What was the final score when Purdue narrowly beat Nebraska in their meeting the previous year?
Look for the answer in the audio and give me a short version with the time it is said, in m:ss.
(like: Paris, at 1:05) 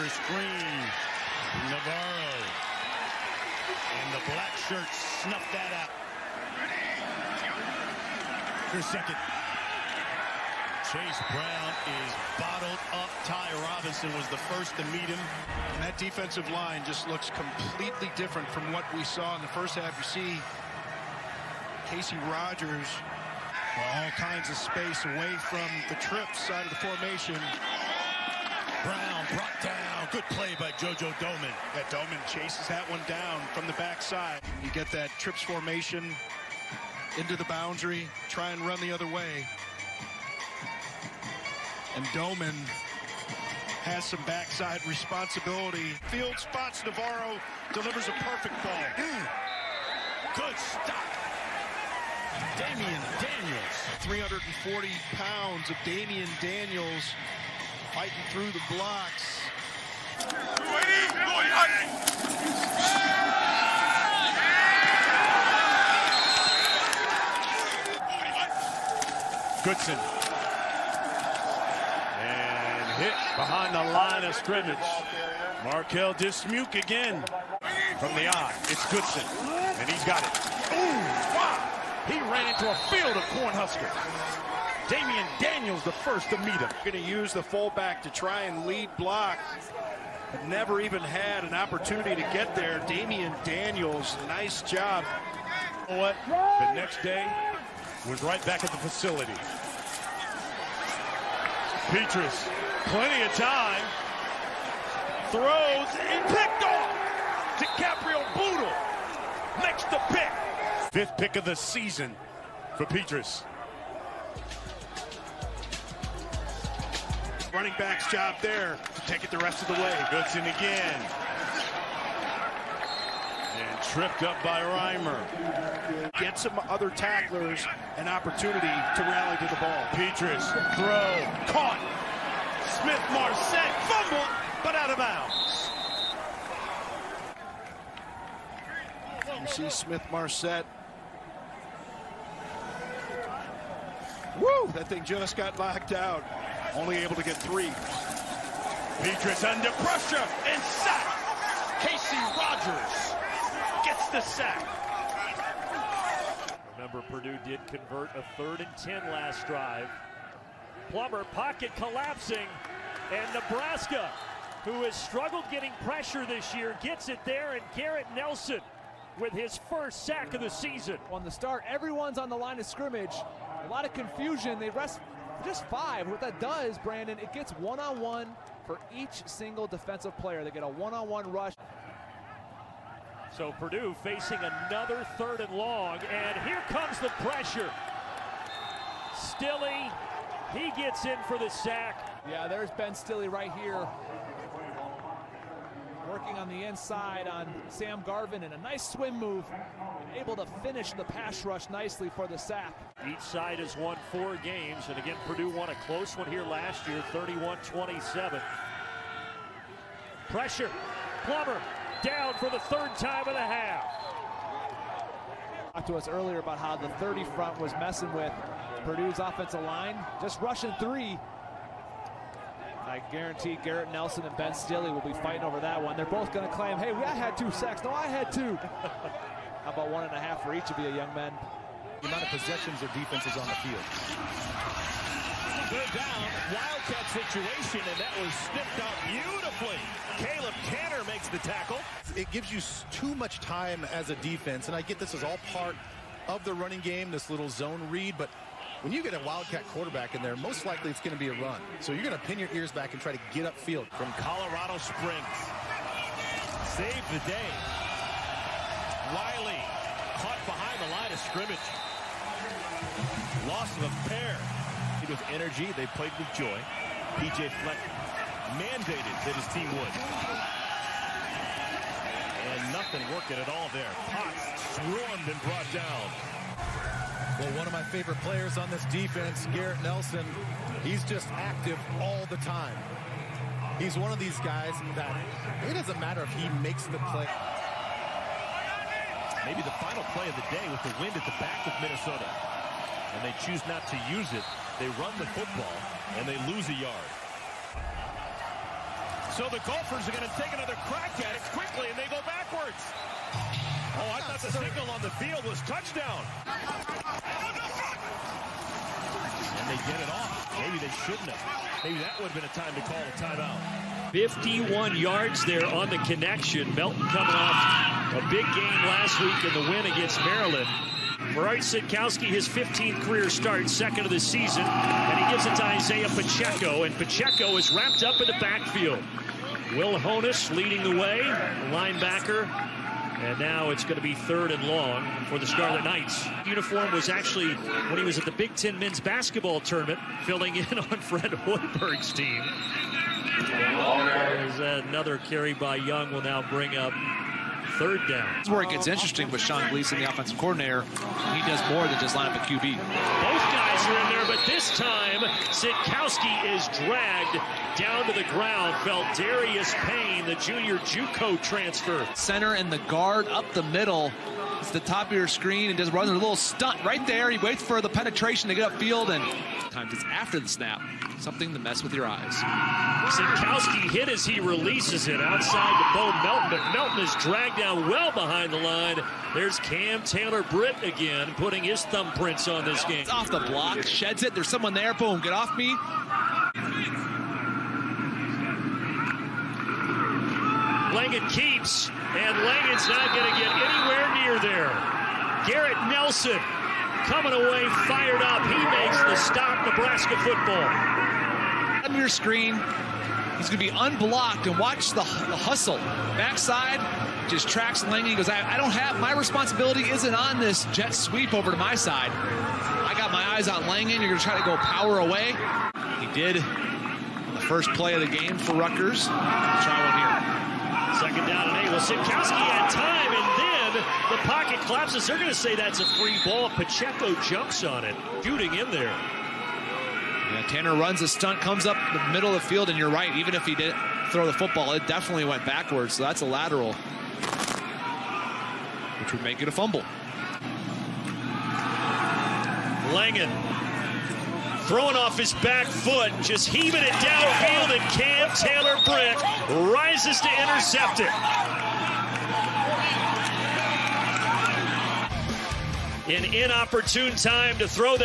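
31-27, at 3:27.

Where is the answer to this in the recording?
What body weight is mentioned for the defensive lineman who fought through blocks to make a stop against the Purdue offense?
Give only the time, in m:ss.
0:53.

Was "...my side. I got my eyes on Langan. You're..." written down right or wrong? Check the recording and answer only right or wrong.
right.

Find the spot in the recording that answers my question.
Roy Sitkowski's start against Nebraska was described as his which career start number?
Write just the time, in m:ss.
5:22.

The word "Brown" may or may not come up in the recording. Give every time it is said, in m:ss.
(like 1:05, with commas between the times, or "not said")
0:11, 0:28.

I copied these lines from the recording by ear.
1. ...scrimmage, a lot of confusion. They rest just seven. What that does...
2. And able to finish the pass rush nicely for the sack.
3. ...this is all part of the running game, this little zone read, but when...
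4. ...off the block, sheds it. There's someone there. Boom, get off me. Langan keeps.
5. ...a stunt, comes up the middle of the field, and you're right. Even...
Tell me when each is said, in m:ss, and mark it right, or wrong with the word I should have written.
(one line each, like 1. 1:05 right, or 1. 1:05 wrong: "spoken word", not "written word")
1. 2:52 wrong: "five", not "seven"
2. 3:19 right
3. 4:04 right
4. 6:23 right
5. 7:11 right.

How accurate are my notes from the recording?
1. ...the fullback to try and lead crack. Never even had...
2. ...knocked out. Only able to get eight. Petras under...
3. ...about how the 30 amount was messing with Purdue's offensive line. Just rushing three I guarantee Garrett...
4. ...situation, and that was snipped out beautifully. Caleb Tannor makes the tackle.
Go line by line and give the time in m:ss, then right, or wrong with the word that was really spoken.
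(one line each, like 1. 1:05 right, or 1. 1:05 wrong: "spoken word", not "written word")
1. 1:27 wrong: "block", not "crack"
2. 2:25 wrong: "three", not "eight"
3. 3:36 wrong: "front", not "amount"
4. 3:57 right.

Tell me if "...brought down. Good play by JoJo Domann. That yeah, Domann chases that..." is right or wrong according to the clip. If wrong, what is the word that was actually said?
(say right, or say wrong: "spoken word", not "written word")
right.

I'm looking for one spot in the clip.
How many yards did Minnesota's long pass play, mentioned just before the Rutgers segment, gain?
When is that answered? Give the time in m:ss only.
5:14.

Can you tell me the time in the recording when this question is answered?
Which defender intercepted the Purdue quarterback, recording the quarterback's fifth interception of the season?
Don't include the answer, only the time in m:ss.
1:47.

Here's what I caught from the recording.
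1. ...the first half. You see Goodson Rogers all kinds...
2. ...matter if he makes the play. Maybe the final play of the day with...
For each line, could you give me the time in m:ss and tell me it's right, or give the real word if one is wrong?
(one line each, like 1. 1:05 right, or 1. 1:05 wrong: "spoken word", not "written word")
1. 0:19 wrong: "Casey", not "Goodson"
2. 4:45 right.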